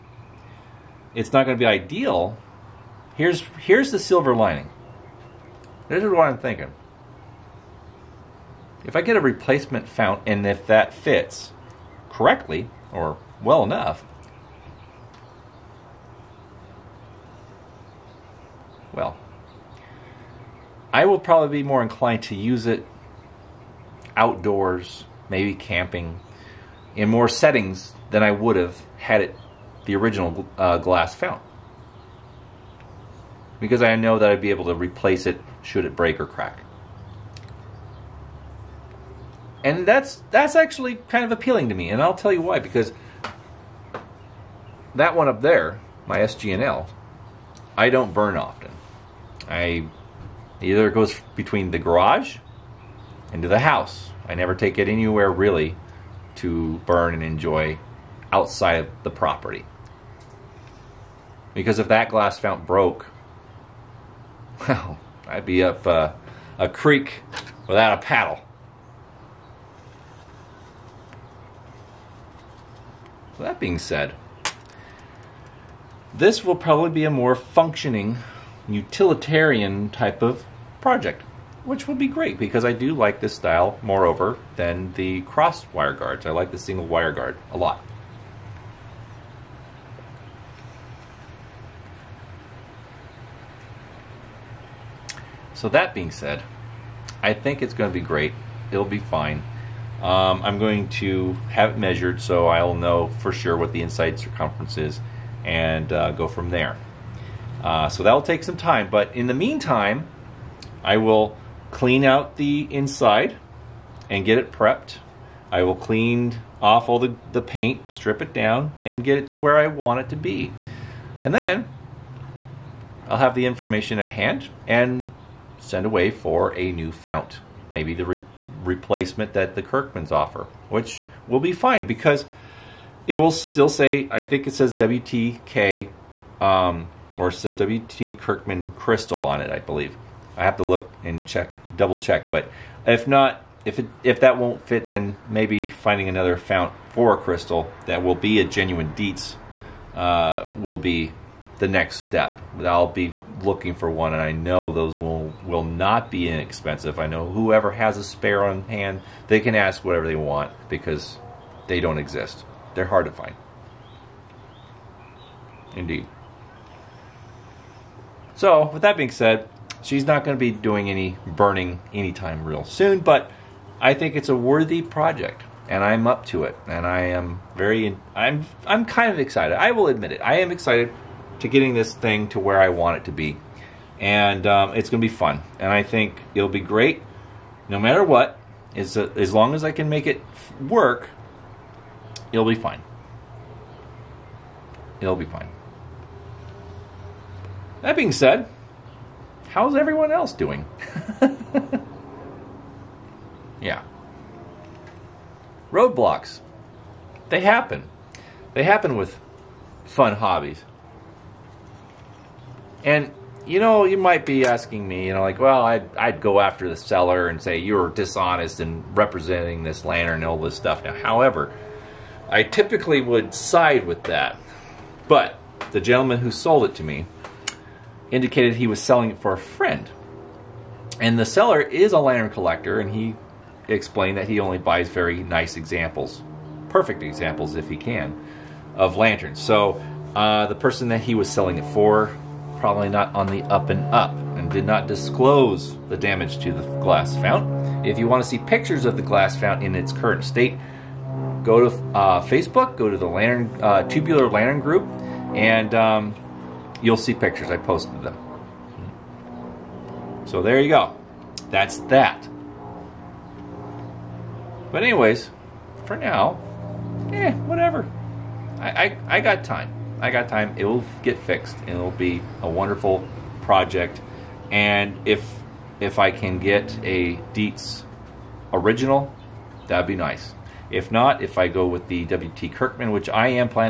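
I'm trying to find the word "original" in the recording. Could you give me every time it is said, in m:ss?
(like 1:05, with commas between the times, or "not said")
0:29, 4:38.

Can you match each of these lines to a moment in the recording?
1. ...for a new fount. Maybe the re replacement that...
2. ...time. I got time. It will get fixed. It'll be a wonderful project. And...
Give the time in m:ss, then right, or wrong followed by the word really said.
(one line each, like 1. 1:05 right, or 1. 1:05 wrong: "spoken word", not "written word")
1. 2:06 right
2. 4:29 right.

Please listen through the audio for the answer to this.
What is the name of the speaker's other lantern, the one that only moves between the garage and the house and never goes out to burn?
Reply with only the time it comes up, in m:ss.
0:46.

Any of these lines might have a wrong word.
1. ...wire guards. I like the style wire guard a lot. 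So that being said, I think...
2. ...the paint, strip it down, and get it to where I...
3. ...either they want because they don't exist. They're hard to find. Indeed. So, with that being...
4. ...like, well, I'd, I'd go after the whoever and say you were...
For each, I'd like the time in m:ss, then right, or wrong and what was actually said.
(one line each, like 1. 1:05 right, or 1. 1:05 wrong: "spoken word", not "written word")
1. 1:25 wrong: "single", not "style"
2. 1:57 right
3. 2:39 wrong: "whatever", not "either"
4. 3:35 wrong: "seller", not "whoever".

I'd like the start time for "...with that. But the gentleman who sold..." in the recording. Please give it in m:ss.
3:43.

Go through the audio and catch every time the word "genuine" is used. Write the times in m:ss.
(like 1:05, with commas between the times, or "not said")
2:28.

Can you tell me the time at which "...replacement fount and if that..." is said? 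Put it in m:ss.
0:09.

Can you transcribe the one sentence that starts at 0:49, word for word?
I either goes between the garage into the house.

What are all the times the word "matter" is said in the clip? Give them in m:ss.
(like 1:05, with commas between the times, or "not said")
3:07.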